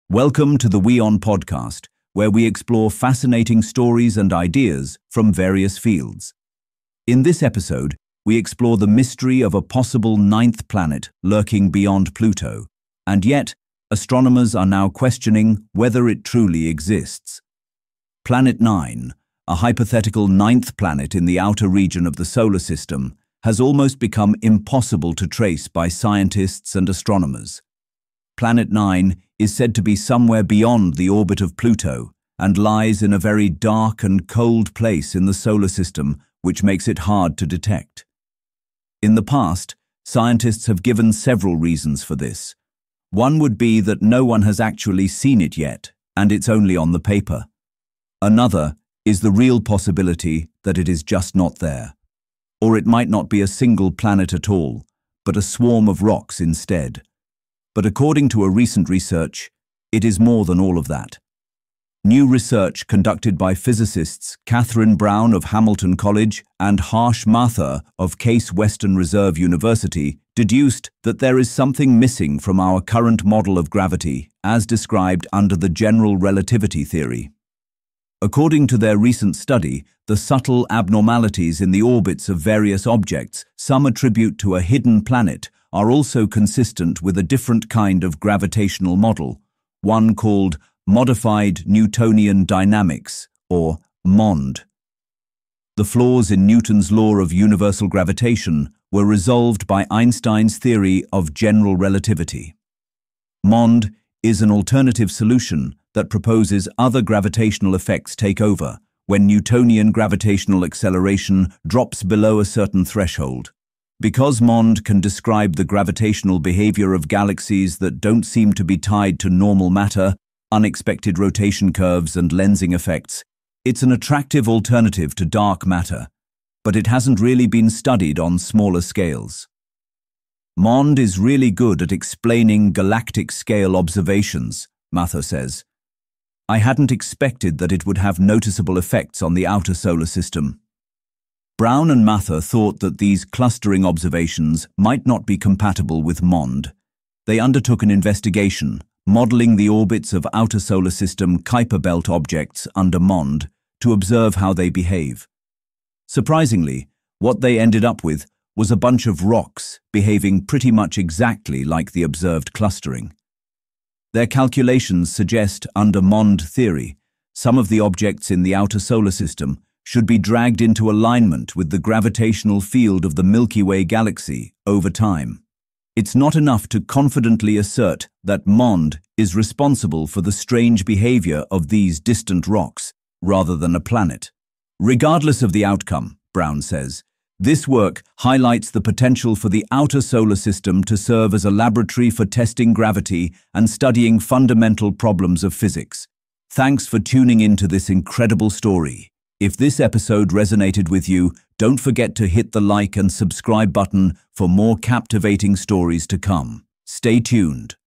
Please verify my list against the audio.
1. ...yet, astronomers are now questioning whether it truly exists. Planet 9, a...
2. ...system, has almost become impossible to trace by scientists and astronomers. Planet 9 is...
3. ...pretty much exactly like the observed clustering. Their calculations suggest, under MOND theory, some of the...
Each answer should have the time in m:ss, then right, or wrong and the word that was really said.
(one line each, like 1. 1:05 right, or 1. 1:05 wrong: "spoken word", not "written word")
1. 0:13 right
2. 0:22 right
3. 2:40 right.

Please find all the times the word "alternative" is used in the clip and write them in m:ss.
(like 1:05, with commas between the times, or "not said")
1:44, 2:04.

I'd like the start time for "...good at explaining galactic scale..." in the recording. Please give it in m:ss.
2:11.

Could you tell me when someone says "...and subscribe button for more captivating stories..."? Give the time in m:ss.
3:22.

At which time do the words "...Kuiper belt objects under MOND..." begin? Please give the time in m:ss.
2:31.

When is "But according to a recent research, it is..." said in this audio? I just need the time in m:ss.
0:57.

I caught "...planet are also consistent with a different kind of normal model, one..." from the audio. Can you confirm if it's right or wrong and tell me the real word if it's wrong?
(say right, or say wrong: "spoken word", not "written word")
wrong: "gravitational", not "normal".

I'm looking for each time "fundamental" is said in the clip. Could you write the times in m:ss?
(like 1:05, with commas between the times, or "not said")
3:14.